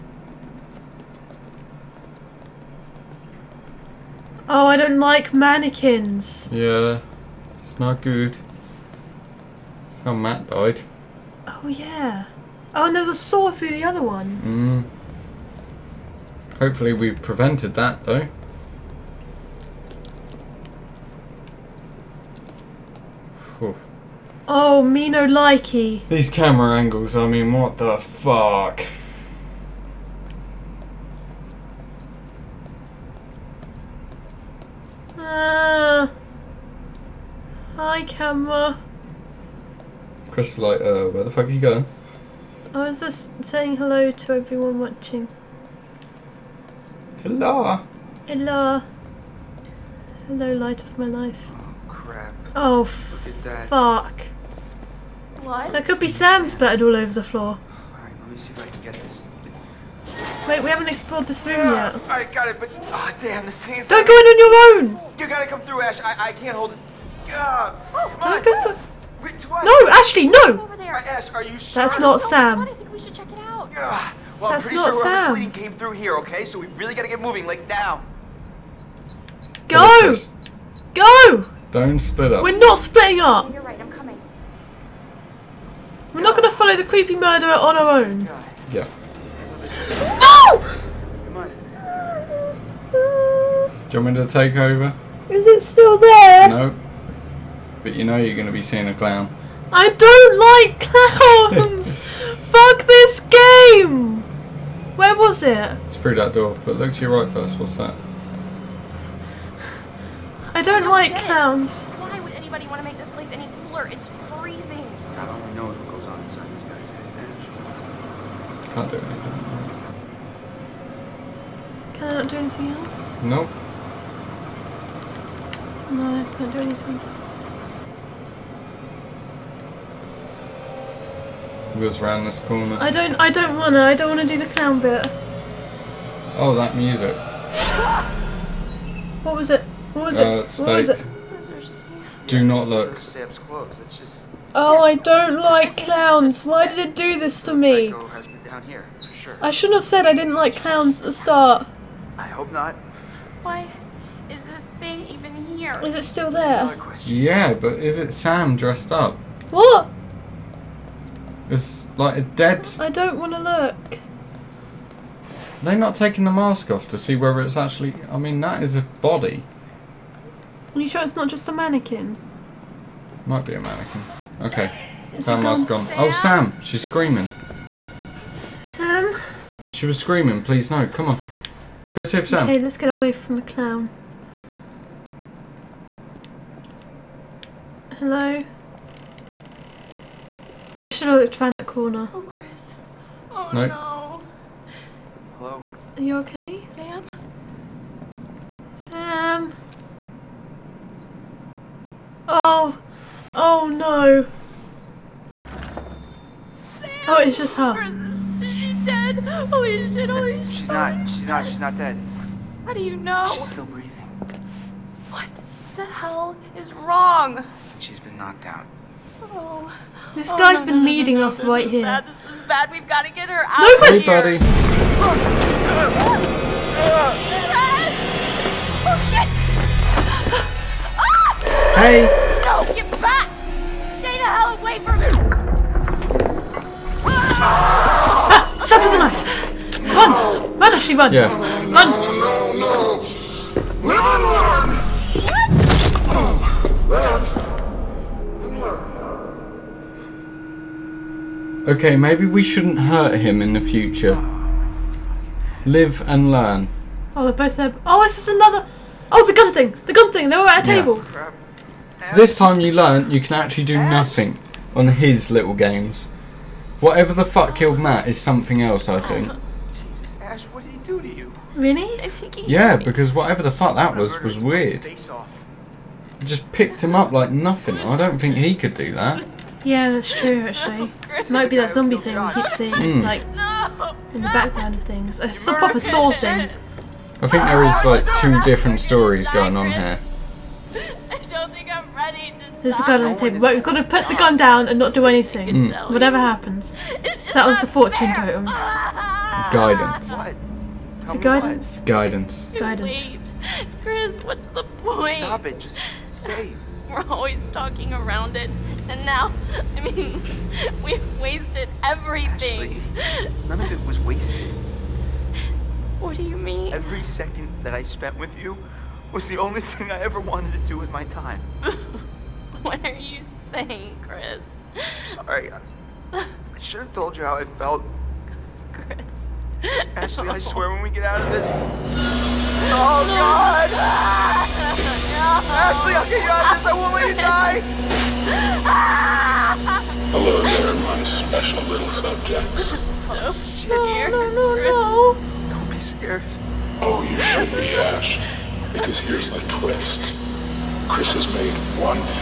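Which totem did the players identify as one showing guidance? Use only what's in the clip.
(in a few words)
Fortune totem.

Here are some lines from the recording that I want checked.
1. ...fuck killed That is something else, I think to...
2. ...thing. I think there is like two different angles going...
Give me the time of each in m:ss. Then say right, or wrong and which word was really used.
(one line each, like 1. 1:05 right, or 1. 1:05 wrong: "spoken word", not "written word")
1. 4:27 wrong: "Matt", not "That"
2. 4:46 wrong: "stories", not "angles".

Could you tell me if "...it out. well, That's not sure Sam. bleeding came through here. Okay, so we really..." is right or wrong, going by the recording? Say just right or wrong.
right.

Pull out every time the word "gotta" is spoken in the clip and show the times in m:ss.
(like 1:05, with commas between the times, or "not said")
1:05, 1:16.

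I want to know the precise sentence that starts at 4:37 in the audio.
I don't think he could do that.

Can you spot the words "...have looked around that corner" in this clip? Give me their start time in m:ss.
3:11.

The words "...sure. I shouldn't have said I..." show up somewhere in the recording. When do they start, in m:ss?
2:29.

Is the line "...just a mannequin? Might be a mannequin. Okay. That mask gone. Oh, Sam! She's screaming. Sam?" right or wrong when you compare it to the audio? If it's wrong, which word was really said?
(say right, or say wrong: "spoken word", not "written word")
right.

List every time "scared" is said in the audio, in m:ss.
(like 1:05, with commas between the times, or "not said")
5:45.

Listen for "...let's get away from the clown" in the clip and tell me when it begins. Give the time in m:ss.
3:02.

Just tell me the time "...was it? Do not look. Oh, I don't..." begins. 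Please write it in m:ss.
2:21.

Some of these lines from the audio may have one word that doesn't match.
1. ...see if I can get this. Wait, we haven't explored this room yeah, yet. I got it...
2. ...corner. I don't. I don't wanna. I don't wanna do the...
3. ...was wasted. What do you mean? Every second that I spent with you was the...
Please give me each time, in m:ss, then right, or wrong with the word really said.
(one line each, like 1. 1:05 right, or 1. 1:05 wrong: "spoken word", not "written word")
1. 0:58 right
2. 2:12 right
3. 5:13 right.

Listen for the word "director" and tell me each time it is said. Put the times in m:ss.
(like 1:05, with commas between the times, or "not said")
not said.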